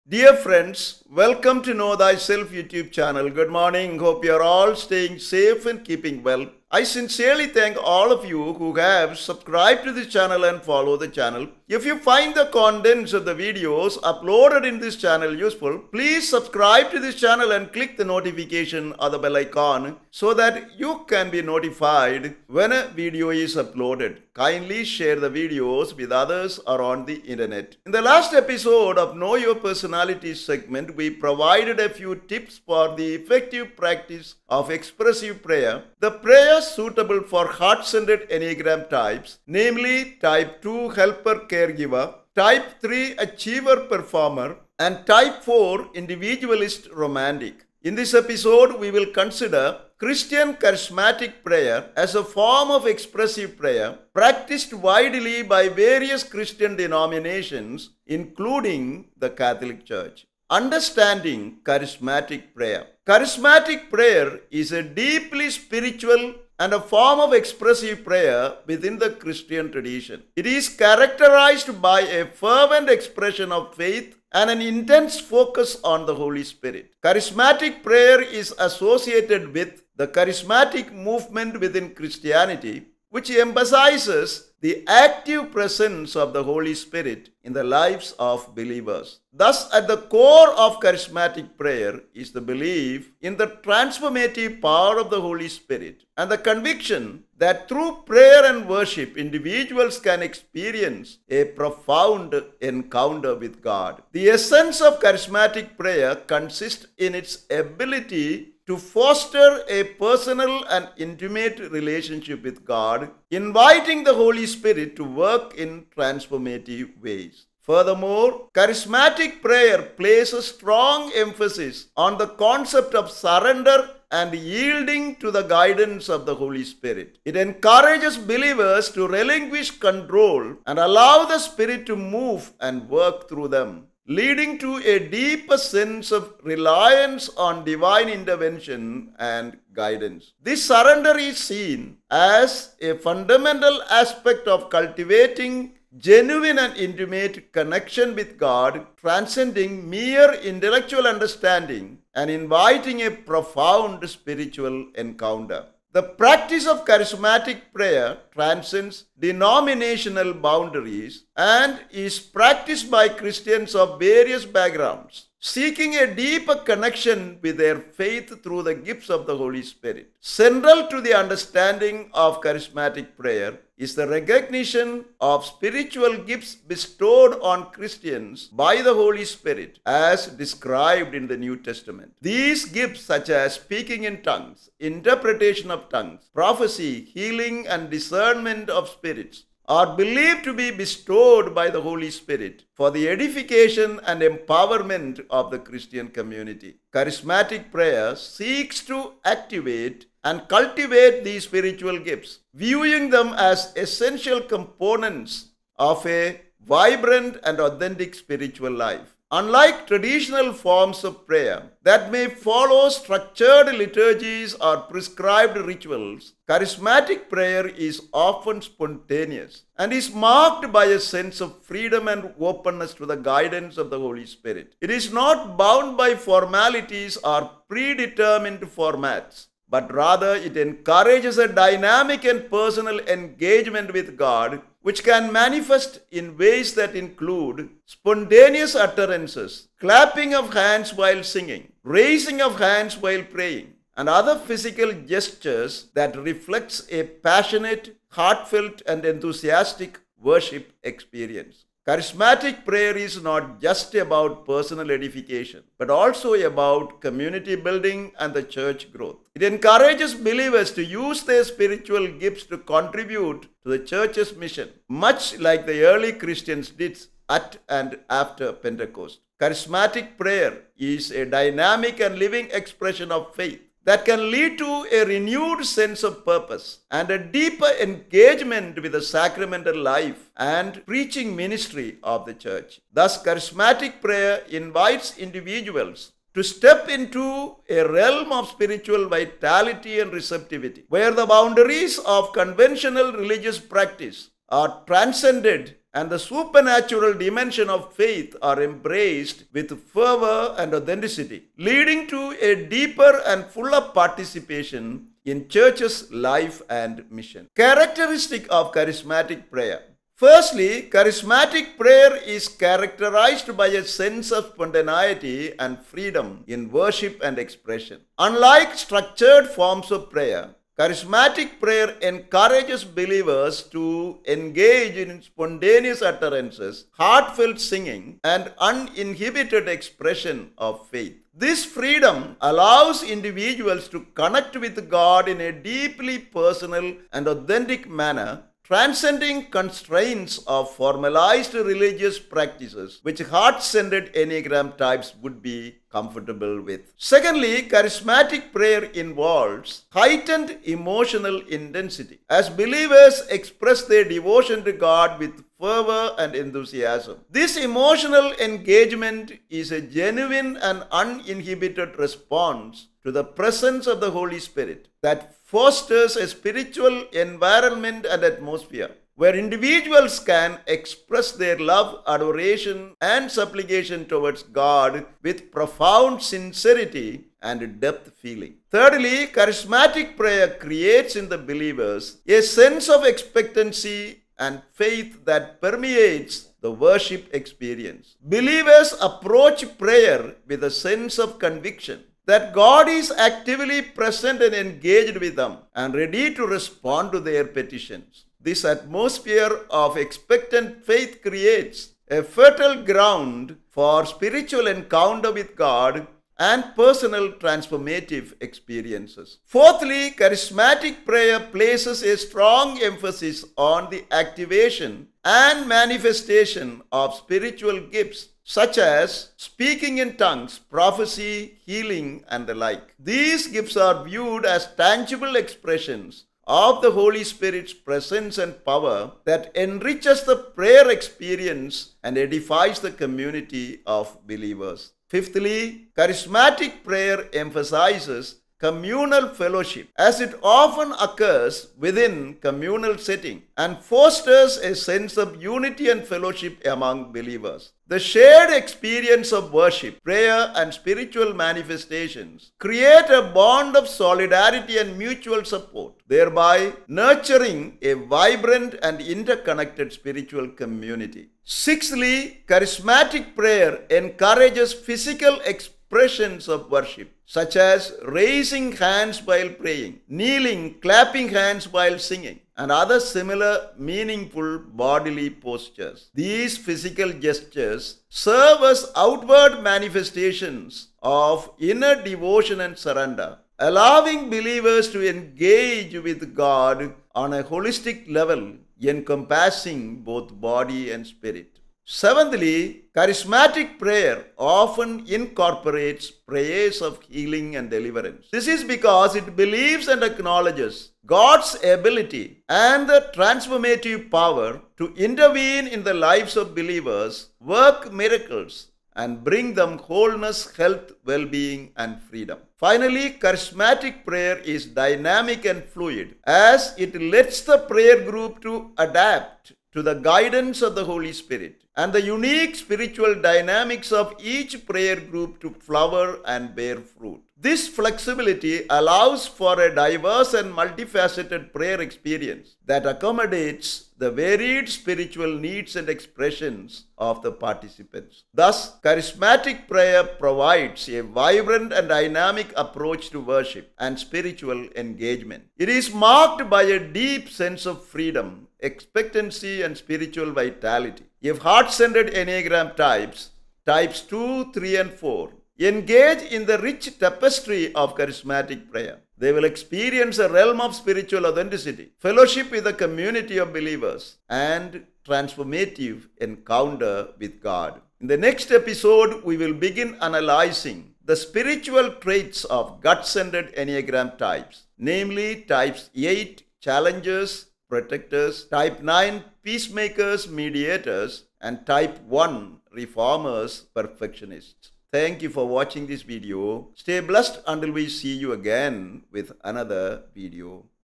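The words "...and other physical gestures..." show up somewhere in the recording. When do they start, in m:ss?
4:03.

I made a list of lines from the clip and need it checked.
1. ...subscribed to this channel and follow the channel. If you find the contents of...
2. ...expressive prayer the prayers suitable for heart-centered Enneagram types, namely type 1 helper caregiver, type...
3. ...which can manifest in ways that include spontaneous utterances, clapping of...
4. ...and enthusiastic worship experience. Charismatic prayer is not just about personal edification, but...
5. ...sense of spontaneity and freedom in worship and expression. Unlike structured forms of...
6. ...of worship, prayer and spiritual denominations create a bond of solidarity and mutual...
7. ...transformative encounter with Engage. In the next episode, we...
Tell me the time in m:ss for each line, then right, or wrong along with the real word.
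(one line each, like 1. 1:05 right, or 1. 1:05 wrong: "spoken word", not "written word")
1. 0:09 right
2. 0:34 wrong: "2", not "1"
3. 3:54 right
4. 4:08 right
5. 5:13 right
6. 7:29 wrong: "manifestations", not "denominations"
7. 9:25 wrong: "God", not "Engage".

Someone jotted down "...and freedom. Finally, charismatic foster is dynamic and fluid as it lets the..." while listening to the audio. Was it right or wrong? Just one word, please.
wrong.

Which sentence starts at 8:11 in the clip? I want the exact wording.
Seventhly, charismatic prayer often incorporates prayers of healing and deliverance.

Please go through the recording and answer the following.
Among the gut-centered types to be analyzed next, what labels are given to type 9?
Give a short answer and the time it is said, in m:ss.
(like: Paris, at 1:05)
peacemakers, mediators, at 9:39.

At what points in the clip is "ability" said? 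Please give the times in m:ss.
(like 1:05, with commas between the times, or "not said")
1:47, 8:21.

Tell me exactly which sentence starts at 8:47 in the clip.
This flexibility allows for a diverse and multifaceted prayer experience that accommodates the varied spiritual needs and expressions of the participants.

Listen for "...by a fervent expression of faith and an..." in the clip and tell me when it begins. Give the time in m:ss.
1:11.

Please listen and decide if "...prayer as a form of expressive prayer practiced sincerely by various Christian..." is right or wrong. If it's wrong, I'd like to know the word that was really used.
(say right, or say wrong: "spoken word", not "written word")
wrong: "widely", not "sincerely".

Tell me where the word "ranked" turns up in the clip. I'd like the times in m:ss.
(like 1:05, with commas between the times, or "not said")
not said.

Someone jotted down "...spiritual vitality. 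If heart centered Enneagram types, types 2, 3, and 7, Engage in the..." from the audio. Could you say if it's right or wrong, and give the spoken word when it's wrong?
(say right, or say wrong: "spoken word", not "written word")
wrong: "4", not "7".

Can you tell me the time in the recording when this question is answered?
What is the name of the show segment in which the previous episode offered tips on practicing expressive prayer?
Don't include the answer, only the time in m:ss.
0:29.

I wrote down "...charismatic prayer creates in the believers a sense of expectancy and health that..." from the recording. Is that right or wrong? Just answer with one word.
wrong.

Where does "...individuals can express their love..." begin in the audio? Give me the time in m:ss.
6:09.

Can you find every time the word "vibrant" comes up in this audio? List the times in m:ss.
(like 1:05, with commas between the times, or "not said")
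3:26, 7:38, 9:01.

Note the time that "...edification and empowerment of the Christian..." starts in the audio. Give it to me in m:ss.
3:13.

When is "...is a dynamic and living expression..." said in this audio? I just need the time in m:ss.
4:30.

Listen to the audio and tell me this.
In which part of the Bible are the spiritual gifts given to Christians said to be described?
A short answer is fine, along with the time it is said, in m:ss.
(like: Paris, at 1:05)
New Testament, at 3:01.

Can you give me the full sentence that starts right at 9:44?
Thank you for watching this video.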